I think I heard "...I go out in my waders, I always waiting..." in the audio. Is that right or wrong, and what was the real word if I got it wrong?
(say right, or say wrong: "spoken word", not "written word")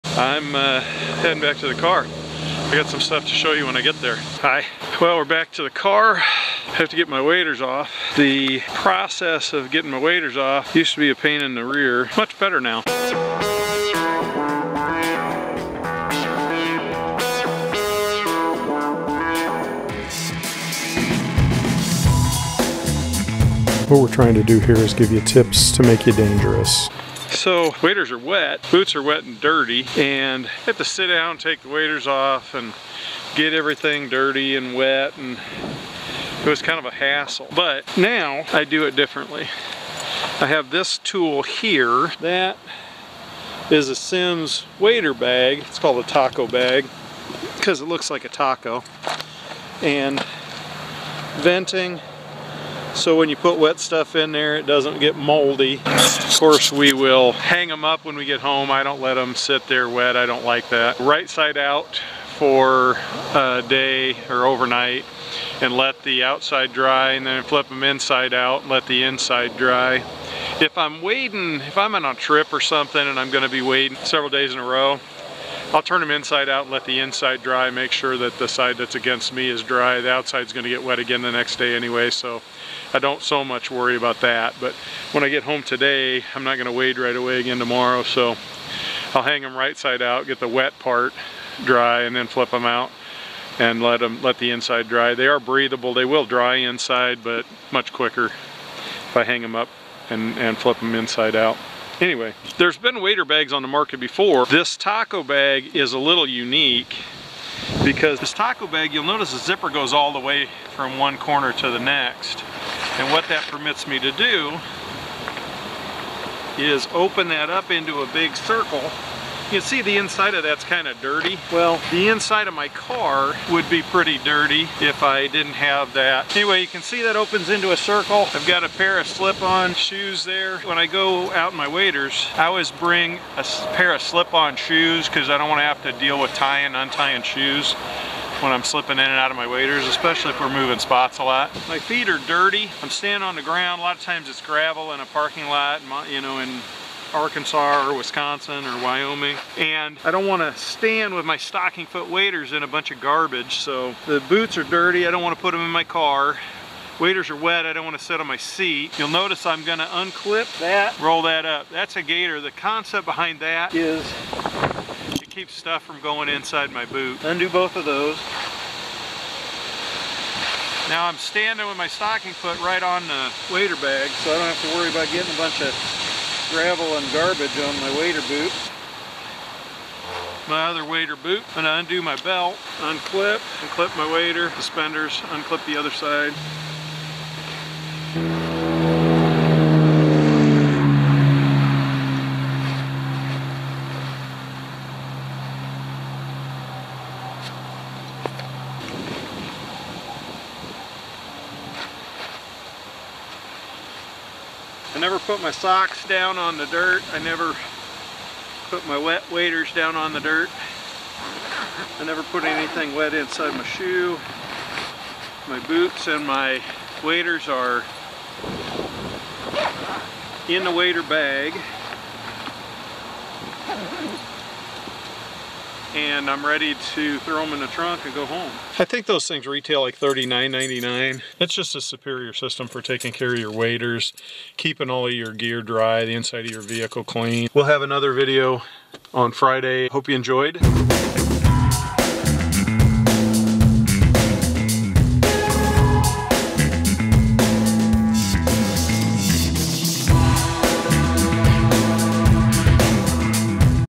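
wrong: "bring", not "waiting".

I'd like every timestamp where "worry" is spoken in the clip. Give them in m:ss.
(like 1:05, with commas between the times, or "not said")
1:23, 2:54.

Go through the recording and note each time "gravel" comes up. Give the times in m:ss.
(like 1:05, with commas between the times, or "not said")
2:24, 2:56.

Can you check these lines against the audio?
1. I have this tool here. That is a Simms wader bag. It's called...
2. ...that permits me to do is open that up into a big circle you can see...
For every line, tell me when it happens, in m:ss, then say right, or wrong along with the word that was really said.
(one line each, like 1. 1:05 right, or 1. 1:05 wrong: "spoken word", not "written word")
1. 0:40 right
2. 1:53 right.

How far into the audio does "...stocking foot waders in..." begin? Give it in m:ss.
2:31.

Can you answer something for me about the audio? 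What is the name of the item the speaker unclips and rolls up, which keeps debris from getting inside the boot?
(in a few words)
Gator.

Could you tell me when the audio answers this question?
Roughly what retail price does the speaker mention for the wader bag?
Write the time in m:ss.
3:49.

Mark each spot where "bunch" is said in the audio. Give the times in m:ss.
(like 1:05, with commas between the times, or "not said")
2:32, 2:55.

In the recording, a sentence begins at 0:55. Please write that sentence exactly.
Of course we will hang them up when we get home.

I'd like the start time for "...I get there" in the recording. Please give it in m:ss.
0:03.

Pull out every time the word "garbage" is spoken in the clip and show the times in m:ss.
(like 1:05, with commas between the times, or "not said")
2:33, 2:57.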